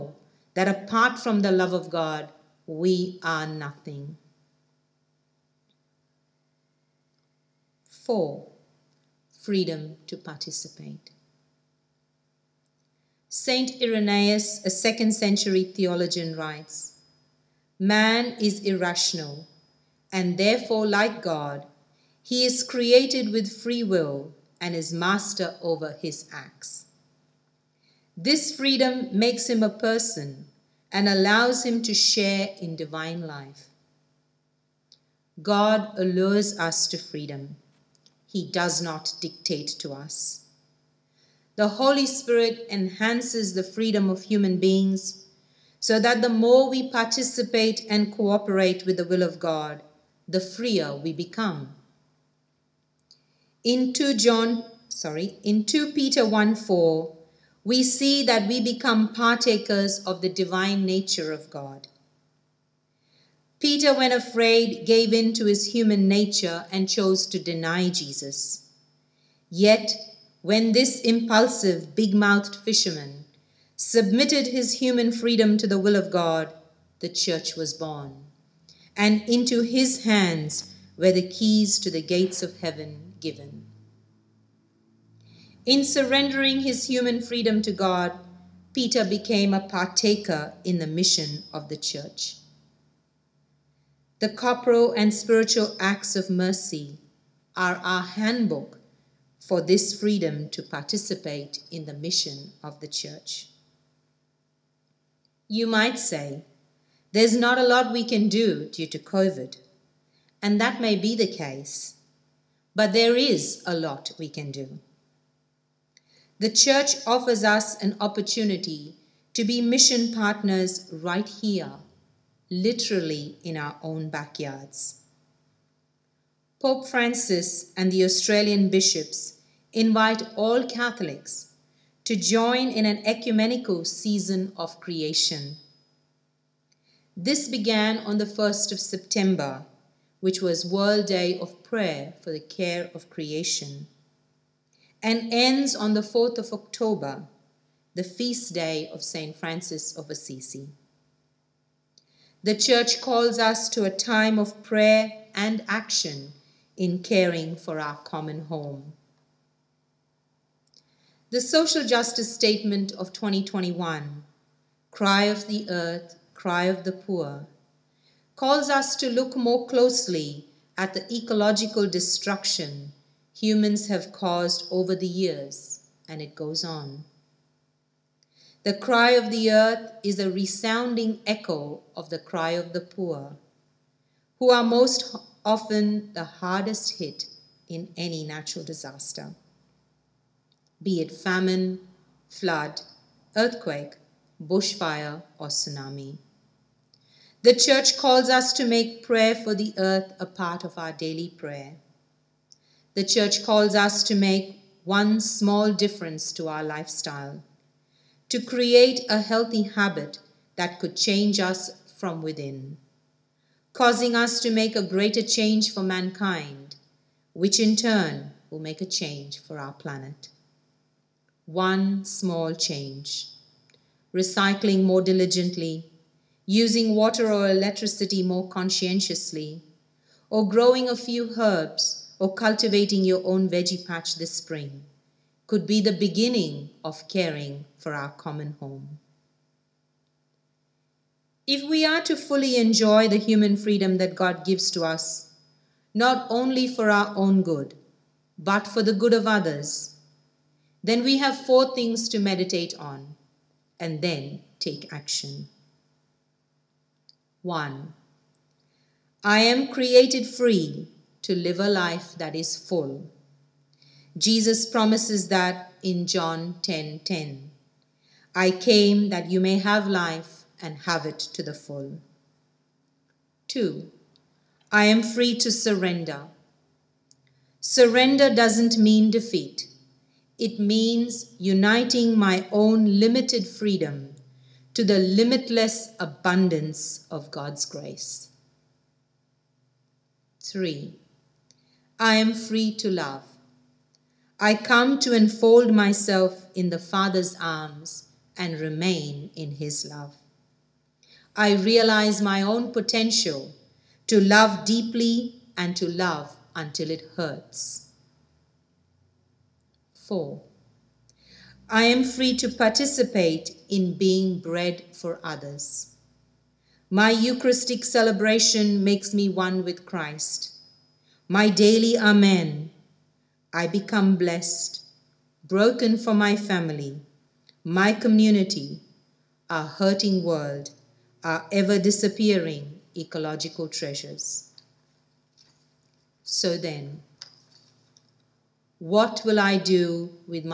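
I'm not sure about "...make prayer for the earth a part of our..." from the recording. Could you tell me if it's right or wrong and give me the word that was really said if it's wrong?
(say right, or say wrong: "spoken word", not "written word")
right.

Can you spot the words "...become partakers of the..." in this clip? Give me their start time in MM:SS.
00:58.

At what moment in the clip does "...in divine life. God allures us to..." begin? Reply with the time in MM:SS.
00:32.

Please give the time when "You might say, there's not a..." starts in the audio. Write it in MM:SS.
01:45.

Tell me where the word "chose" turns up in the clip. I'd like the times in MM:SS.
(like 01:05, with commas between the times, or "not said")
01:06.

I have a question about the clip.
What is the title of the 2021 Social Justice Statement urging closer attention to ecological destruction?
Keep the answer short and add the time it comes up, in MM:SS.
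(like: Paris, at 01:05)
Cry of the Earth, Cry of the Poor, at 02:44.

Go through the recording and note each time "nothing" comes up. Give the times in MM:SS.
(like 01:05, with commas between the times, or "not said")
00:03.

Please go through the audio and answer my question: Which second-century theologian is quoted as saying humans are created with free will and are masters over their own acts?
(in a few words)
Saint Irenaeus.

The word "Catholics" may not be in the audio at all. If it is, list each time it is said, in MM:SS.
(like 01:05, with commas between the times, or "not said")
02:10.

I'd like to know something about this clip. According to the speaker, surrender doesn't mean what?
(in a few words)
Defeat.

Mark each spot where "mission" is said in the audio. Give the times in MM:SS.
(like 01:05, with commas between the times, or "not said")
01:30, 01:41, 01:59.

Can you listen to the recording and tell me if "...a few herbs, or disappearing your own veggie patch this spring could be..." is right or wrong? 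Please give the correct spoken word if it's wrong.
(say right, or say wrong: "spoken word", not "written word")
wrong: "cultivating", not "disappearing".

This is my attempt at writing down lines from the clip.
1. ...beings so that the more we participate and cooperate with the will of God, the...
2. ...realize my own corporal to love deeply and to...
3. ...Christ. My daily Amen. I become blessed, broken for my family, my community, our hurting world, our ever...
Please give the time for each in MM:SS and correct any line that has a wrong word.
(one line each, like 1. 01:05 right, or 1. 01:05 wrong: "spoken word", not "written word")
1. 00:44 right
2. 05:01 wrong: "potential", not "corporal"
3. 05:19 right.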